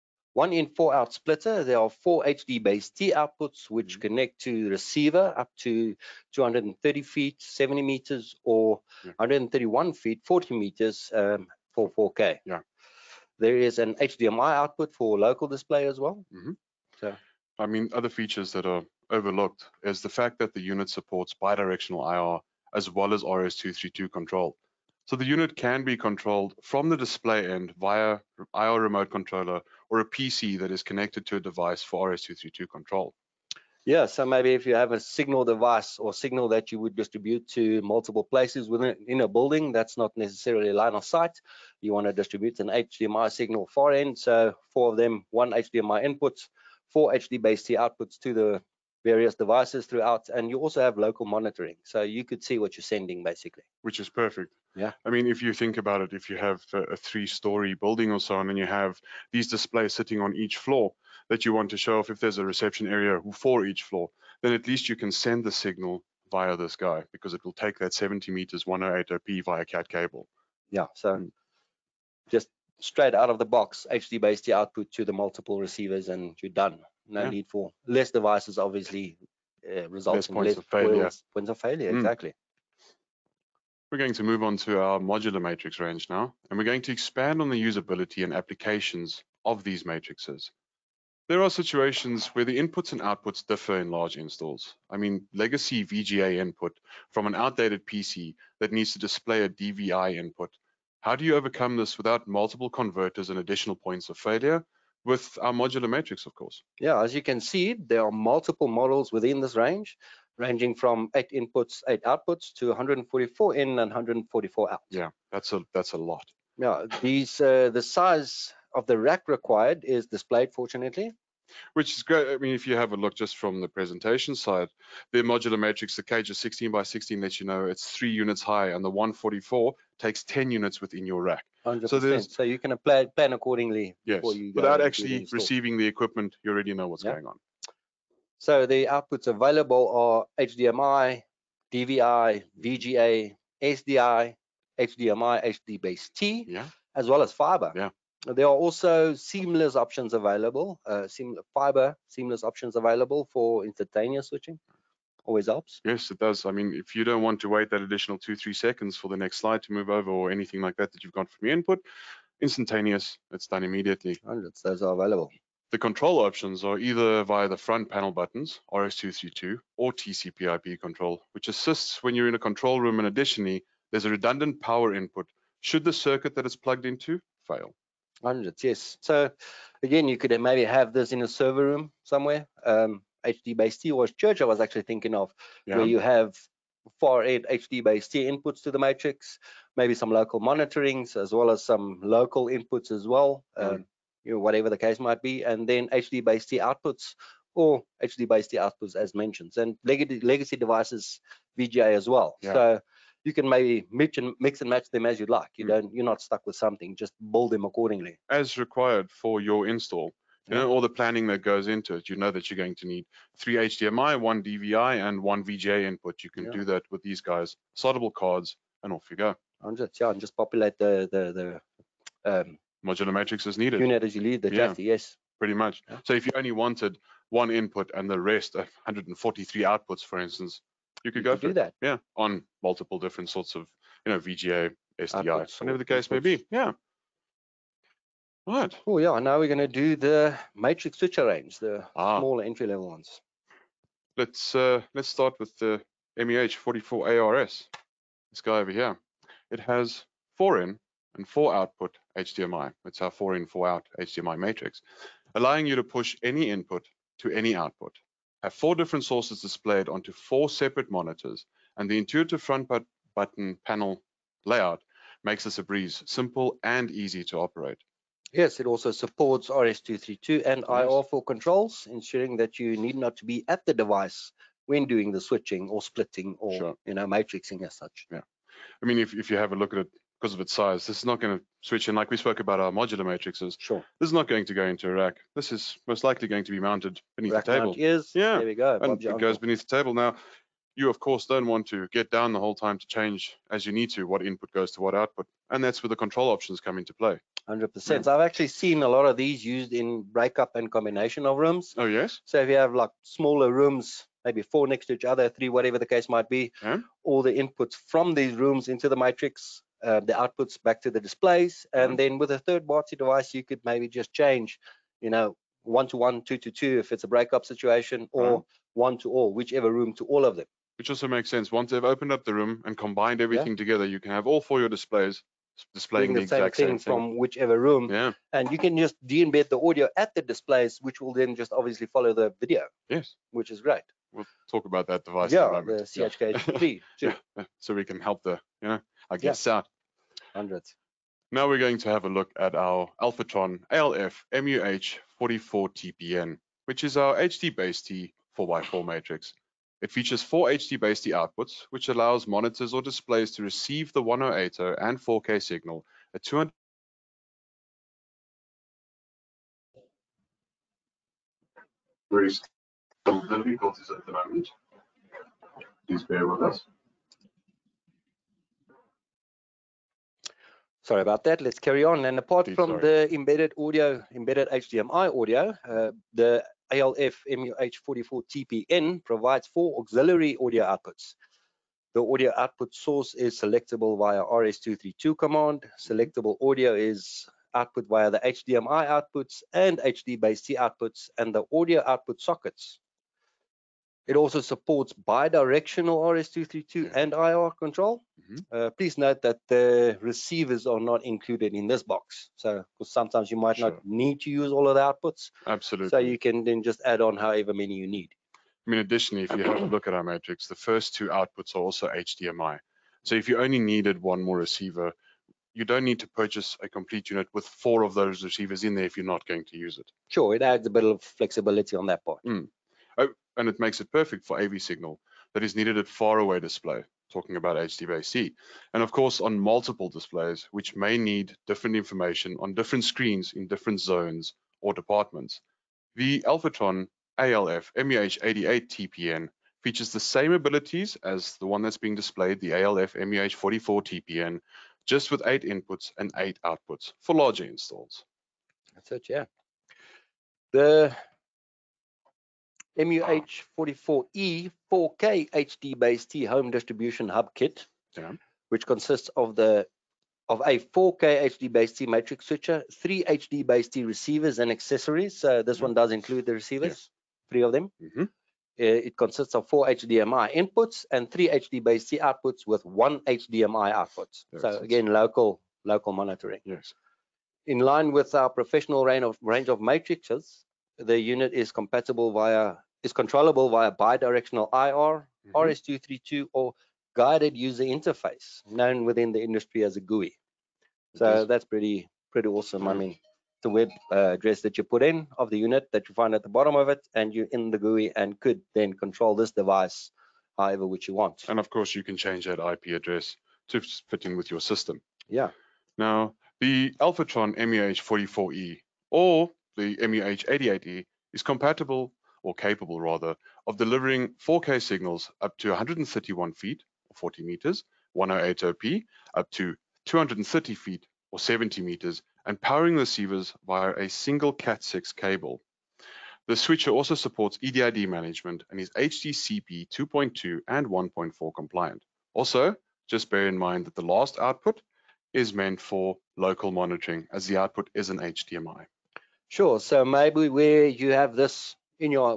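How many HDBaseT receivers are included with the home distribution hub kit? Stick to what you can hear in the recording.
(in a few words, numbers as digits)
3.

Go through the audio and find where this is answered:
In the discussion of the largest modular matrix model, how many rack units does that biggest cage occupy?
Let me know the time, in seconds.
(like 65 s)
130 s.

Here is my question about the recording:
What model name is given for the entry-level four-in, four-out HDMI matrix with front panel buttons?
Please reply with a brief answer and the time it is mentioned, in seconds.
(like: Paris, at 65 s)
MEH 44ARS, at 246 s.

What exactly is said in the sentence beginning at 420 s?
Sure, it adds a bit of flexibility on that part.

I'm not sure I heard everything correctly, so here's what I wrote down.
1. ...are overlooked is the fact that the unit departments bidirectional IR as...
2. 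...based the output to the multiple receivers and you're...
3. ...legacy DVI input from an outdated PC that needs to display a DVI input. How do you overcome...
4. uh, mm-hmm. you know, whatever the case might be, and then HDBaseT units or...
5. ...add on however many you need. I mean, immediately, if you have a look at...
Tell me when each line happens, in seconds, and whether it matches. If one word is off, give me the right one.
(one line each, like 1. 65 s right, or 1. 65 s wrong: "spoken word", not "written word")
1. 18 s wrong: "supports", not "departments"
2. 74 s right
3. 95 s wrong: "VGA", not "DVI"
4. 193 s wrong: "outputs", not "units"
5. 406 s wrong: "additionally", not "immediately".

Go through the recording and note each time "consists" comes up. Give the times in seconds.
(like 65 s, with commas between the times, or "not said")
458 s, 468 s.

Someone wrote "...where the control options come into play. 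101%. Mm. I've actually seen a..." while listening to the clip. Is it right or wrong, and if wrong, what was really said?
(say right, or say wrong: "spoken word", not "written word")
wrong: "100", not "101".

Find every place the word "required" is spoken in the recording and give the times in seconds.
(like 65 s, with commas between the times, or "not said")
119 s, 208 s.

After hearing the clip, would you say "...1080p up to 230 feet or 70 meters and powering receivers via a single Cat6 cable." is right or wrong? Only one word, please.
right.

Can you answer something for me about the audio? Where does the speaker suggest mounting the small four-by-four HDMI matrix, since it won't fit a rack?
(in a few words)
beneath the table.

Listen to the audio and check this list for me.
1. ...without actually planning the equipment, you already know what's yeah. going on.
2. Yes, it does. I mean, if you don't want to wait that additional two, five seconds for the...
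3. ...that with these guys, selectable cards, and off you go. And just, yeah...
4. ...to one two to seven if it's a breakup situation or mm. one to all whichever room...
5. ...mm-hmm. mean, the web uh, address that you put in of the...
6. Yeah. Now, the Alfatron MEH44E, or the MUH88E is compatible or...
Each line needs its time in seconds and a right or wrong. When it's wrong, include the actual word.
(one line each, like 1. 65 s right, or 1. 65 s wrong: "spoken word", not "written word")
1. 134 s wrong: "receiving", not "planning"
2. 155 s wrong: "three", not "five"
3. 216 s wrong: "soldable", not "selectable"
4. 315 s wrong: "two", not "seven"
5. 492 s right
6. 505 s right.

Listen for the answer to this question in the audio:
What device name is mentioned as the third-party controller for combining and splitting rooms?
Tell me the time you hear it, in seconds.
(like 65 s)
335 s.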